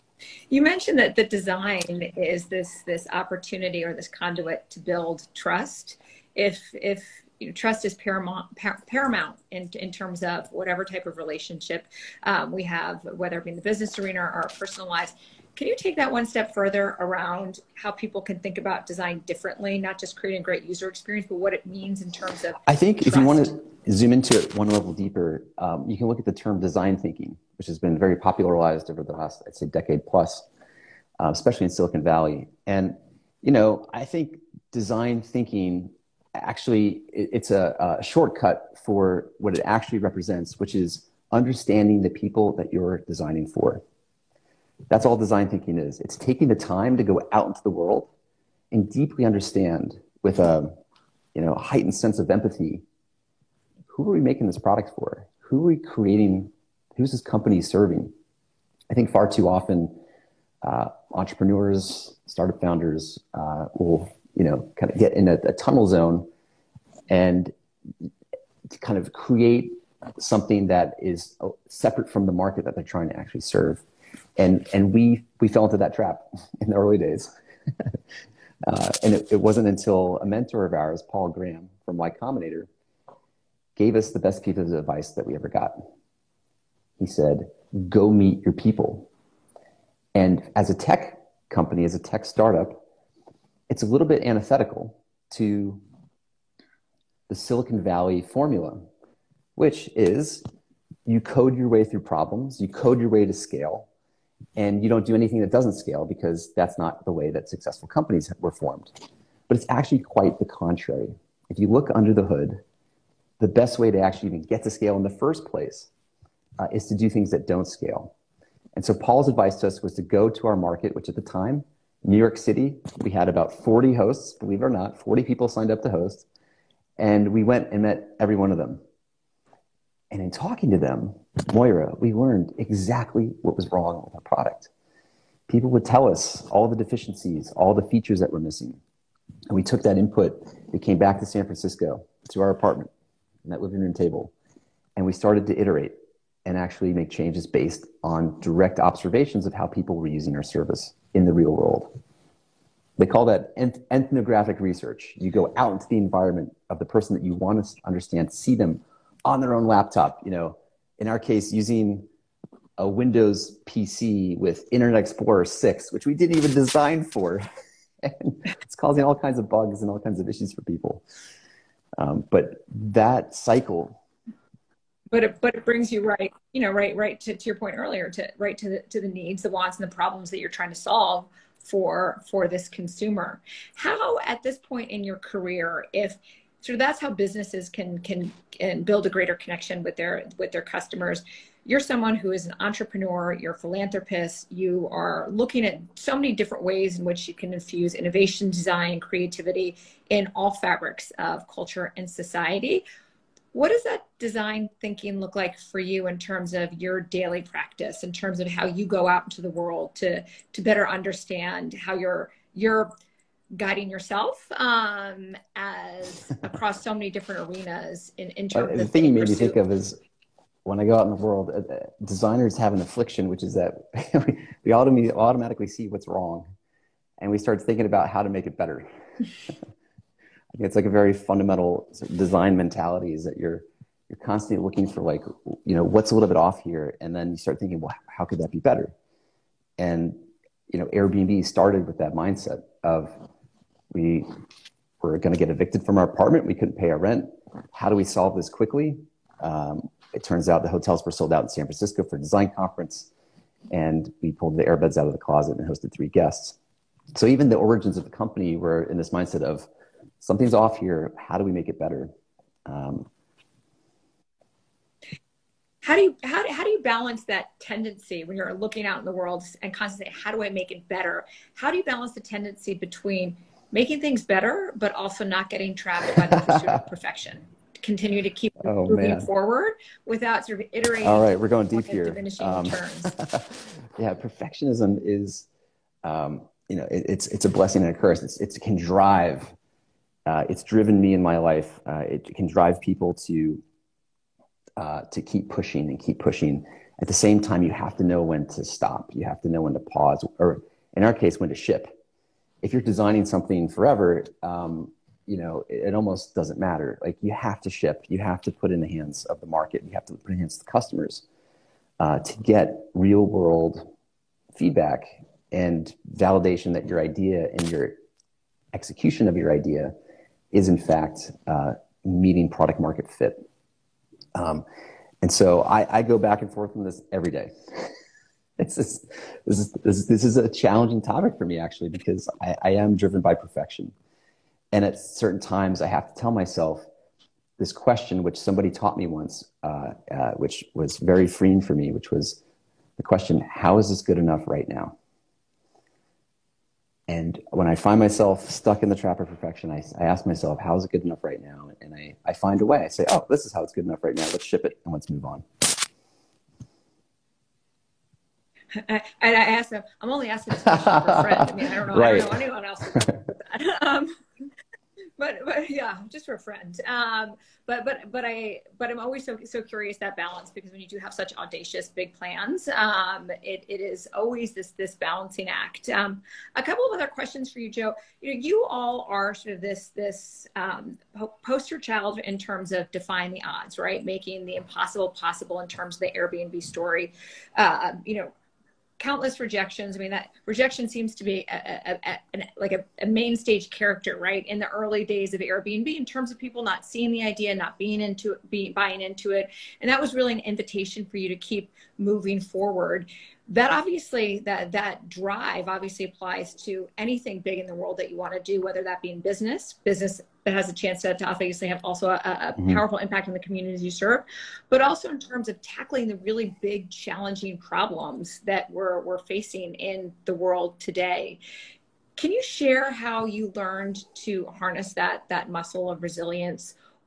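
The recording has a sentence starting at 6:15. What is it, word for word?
Um, a couple of other questions for you, Joe.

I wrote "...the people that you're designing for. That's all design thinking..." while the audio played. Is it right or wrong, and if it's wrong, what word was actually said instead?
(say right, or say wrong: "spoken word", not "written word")
right.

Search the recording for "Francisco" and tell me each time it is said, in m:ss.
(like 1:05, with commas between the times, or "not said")
2:21, 4:11.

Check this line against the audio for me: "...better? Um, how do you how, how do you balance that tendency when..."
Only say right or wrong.
right.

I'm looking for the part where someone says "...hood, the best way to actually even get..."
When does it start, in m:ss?
1:52.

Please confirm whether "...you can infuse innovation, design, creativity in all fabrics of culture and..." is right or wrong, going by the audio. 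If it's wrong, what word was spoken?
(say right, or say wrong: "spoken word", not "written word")
right.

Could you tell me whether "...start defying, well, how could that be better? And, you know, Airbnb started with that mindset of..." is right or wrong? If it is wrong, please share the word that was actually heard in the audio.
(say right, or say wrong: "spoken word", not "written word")
wrong: "thinking", not "defying".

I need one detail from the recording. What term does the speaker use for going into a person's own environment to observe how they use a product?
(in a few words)
ethnographic research.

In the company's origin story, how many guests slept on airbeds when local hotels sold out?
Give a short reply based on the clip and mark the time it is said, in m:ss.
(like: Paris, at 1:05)
3, at 4:15.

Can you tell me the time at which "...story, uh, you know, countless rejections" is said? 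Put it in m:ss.
6:26.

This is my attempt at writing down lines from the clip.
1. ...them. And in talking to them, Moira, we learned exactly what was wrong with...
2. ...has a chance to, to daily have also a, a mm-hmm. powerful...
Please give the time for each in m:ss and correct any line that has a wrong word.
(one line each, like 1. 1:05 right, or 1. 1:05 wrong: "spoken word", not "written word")
1. 2:08 right
2. 6:50 wrong: "obviously", not "daily".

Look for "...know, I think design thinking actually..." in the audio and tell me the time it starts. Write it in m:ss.
0:33.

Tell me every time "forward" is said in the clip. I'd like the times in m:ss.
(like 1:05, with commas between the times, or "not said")
4:39, 6:42.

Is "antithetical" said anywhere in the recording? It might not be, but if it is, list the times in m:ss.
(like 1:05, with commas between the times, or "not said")
1:34.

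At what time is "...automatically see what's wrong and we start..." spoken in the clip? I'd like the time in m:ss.
3:45.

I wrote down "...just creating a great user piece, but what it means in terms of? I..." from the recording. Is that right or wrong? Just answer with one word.
wrong.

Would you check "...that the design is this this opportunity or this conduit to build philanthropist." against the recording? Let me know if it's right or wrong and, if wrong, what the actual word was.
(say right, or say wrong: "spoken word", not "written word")
wrong: "trust", not "philanthropist".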